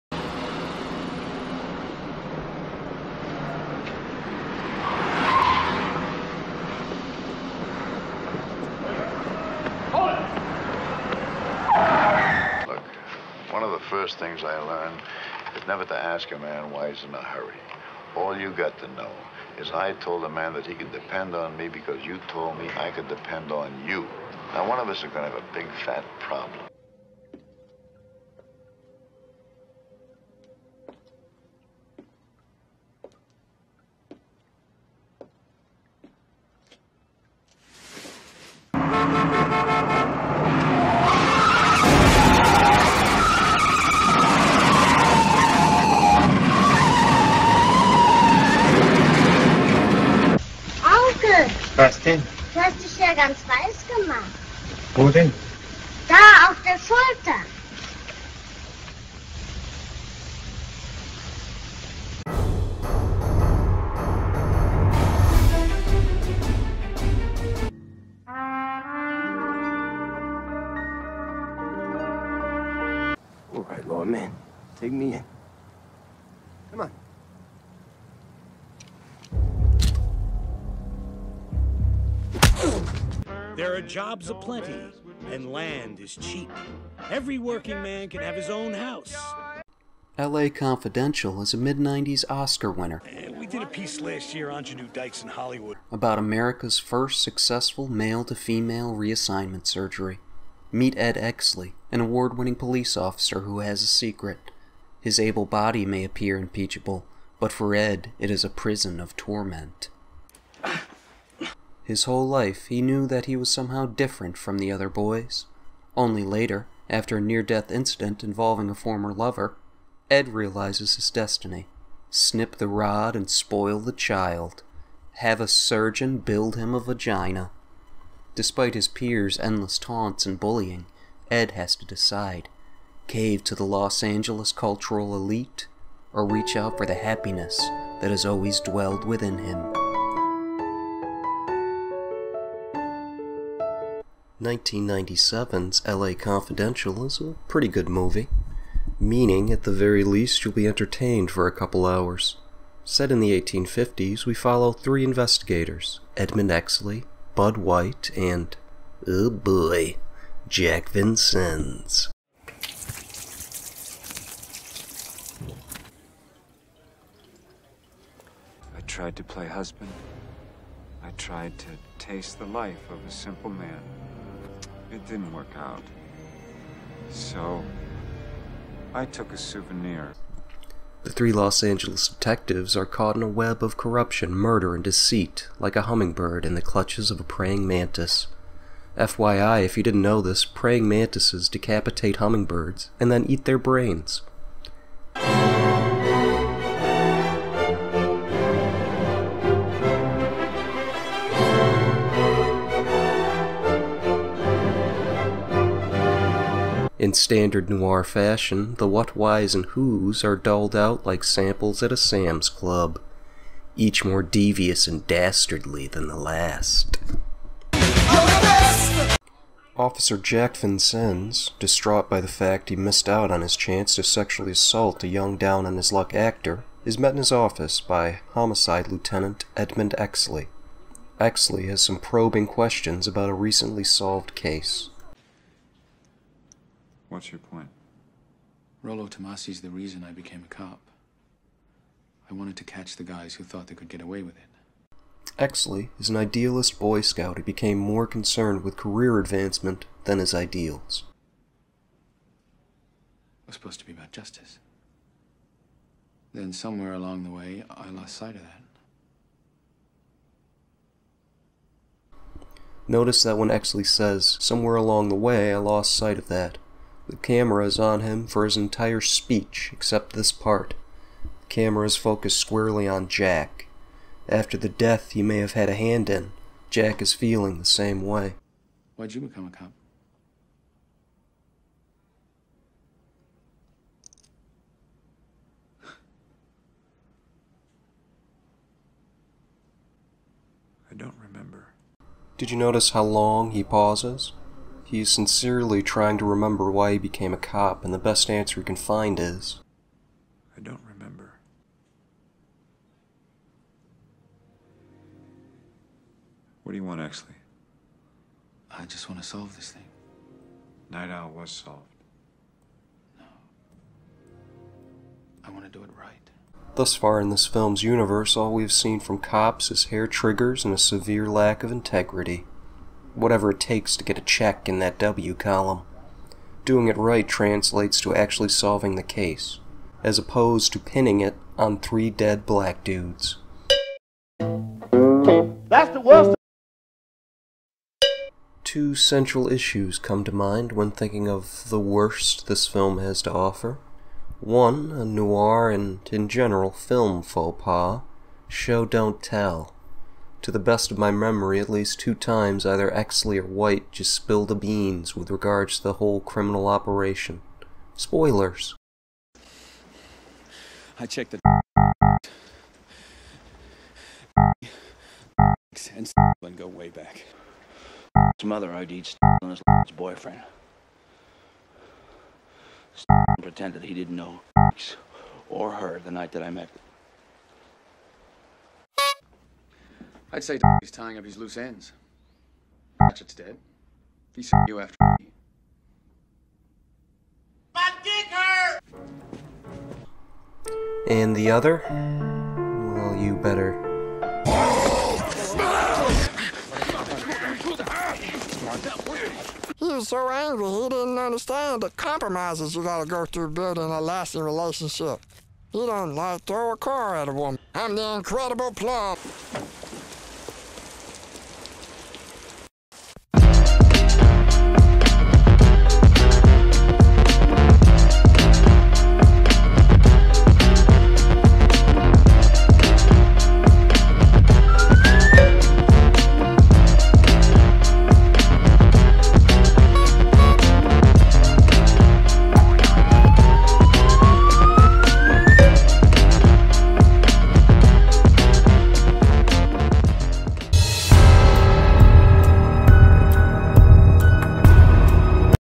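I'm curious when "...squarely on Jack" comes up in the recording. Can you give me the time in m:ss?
4:32.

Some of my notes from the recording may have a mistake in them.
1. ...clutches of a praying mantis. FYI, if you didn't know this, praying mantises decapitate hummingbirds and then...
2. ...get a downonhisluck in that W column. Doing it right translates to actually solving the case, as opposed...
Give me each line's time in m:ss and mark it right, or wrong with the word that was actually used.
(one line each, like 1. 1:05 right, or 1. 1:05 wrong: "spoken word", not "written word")
1. 3:06 right
2. 5:24 wrong: "check", not "downonhisluck".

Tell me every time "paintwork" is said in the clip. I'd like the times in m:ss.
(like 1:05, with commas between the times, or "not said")
not said.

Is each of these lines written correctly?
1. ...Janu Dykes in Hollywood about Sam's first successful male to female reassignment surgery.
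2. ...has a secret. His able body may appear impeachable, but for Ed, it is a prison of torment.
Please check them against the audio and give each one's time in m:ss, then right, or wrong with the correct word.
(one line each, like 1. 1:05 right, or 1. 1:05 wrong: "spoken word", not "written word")
1. 1:34 wrong: "America", not "Sam"
2. 1:43 right.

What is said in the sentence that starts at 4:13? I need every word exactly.
It was supposed to be about justice.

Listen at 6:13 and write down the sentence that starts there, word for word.
Pretended he didn't know or her the night that I met.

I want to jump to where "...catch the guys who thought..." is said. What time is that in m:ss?
4:02.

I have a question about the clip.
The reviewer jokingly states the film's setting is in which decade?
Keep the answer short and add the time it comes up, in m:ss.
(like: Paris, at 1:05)
1850s, at 2:33.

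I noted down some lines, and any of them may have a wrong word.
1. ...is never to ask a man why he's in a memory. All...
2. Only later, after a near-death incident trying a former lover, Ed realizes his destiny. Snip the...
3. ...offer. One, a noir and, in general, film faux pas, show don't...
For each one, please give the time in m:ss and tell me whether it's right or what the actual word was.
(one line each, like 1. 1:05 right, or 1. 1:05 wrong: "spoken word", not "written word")
1. 0:15 wrong: "hurry", not "memory"
2. 1:55 wrong: "involving", not "trying"
3. 5:43 right.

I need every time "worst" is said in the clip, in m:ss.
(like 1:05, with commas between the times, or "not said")
5:36, 5:41.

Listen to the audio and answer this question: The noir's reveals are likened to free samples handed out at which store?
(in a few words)
Sam's Club.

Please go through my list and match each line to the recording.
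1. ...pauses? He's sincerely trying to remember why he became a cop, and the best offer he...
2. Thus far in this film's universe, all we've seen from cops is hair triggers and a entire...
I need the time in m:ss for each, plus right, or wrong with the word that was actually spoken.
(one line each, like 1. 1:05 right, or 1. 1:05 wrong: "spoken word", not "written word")
1. 4:53 wrong: "answer", not "offer"
2. 5:16 wrong: "severe", not "entire".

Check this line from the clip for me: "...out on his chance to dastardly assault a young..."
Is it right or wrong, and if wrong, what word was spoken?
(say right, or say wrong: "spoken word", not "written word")
wrong: "sexually", not "dastardly".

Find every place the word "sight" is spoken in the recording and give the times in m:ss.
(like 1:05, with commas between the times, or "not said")
4:18, 4:25.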